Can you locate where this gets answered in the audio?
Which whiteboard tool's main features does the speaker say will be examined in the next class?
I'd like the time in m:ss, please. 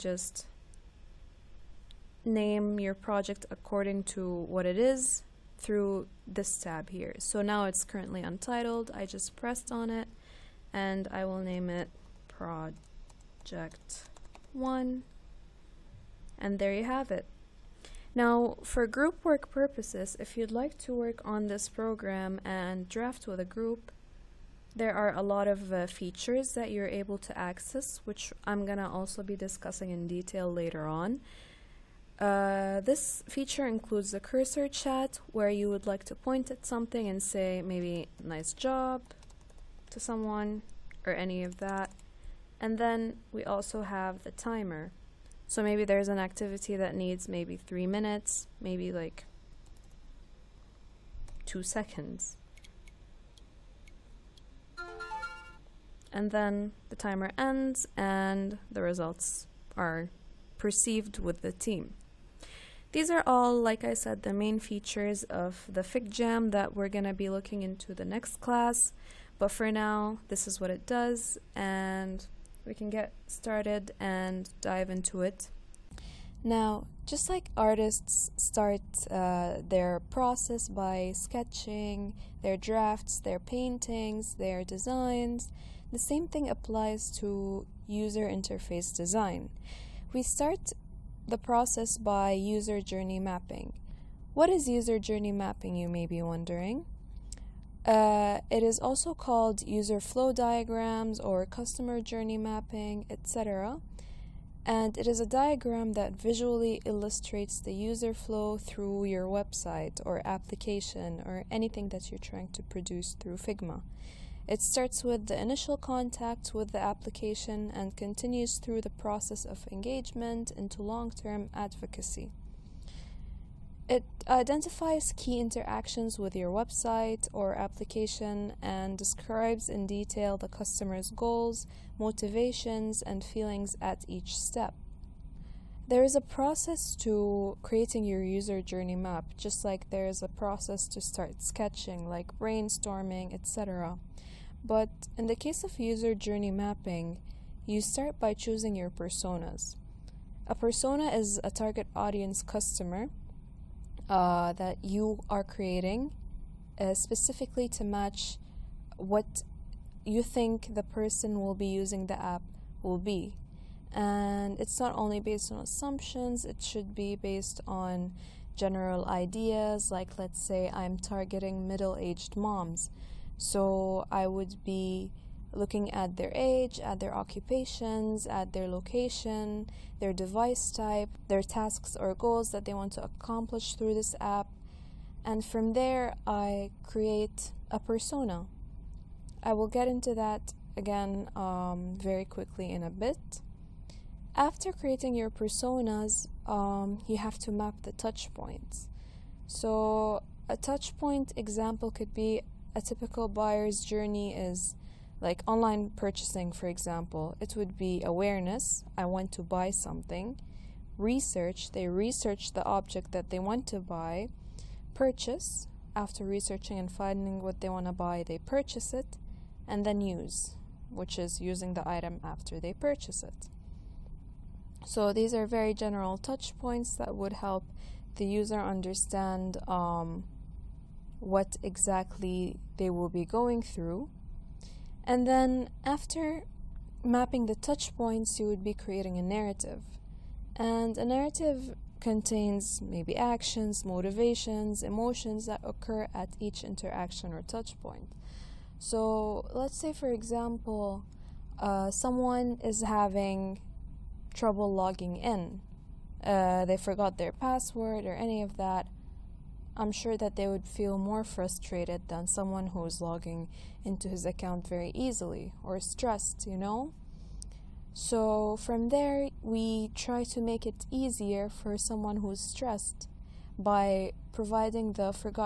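1:05.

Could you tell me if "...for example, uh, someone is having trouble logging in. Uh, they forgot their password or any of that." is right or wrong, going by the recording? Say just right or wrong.
right.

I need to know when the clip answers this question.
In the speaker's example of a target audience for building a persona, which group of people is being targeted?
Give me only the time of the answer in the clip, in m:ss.
2:51.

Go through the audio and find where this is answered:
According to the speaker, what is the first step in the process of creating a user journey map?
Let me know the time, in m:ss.
2:28.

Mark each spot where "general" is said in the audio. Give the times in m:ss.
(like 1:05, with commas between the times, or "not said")
2:48, 3:45.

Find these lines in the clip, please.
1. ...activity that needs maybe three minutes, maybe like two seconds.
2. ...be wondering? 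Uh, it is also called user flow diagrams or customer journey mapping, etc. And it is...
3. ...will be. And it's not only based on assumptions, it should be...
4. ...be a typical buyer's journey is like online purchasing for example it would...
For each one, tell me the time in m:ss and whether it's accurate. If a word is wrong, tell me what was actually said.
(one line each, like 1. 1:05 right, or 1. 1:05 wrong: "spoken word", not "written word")
1. 0:46 right
2. 1:36 right
3. 2:42 right
4. 3:22 right.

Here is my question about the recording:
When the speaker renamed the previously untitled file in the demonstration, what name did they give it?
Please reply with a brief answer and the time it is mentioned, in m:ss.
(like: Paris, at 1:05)
Project 1, at 0:12.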